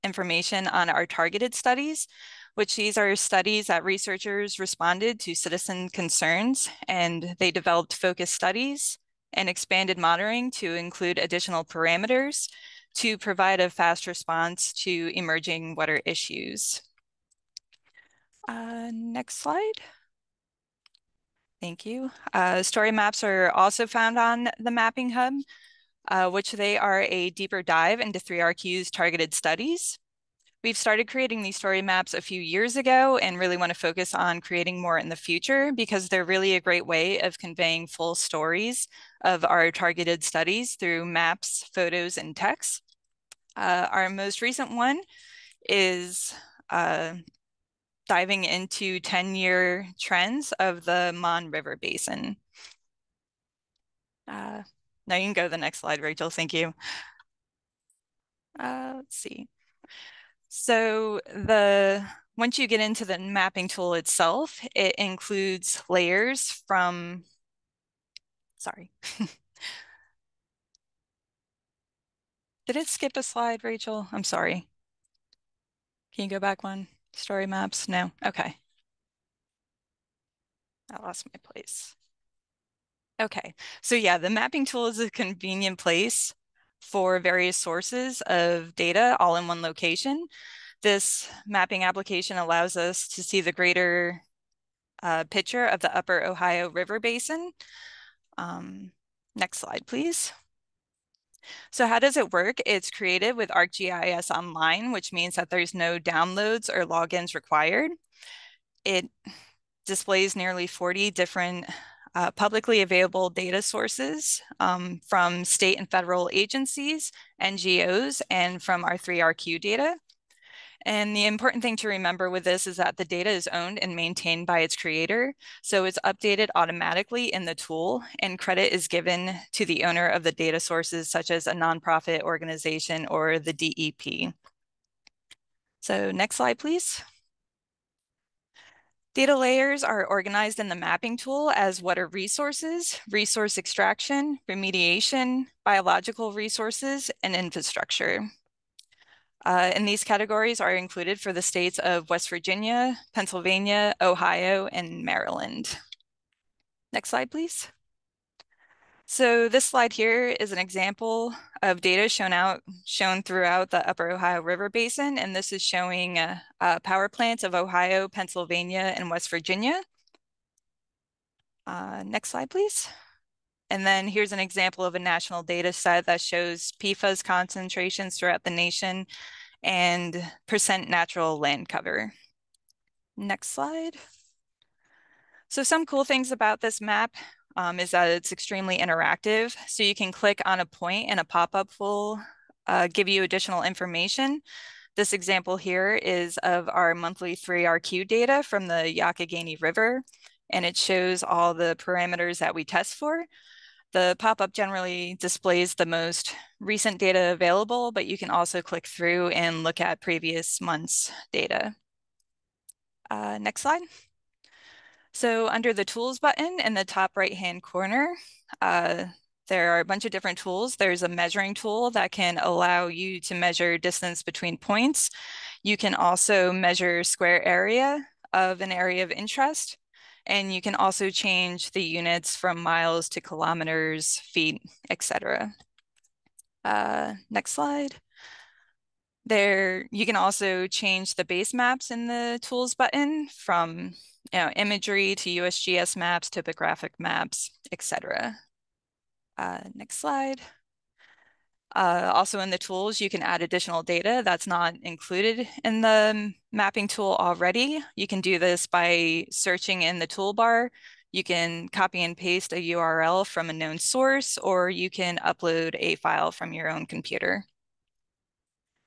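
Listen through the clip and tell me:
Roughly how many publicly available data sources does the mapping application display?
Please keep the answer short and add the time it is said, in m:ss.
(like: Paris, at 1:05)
40, at 1:50.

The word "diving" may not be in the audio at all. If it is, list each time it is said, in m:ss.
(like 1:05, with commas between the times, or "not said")
0:48.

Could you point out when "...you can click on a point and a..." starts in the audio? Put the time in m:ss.
3:09.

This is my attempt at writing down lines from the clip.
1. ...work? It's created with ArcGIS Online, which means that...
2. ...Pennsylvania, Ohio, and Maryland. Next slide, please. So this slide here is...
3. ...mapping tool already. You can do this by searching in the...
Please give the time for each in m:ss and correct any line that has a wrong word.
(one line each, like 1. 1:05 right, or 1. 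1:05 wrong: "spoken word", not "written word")
1. 1:42 right
2. 2:33 right
3. 4:16 right.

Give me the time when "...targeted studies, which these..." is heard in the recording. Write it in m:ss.
0:01.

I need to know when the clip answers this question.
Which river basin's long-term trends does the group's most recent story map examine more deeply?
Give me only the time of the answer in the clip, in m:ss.
0:51.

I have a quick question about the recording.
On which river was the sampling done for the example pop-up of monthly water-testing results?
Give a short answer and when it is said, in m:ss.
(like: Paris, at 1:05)
Youghiogheny River, at 3:18.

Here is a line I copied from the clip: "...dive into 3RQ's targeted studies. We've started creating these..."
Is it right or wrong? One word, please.
right.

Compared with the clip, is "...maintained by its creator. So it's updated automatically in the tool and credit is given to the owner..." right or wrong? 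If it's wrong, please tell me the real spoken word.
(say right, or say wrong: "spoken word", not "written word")
right.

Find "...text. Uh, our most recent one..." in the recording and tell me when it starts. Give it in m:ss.
0:42.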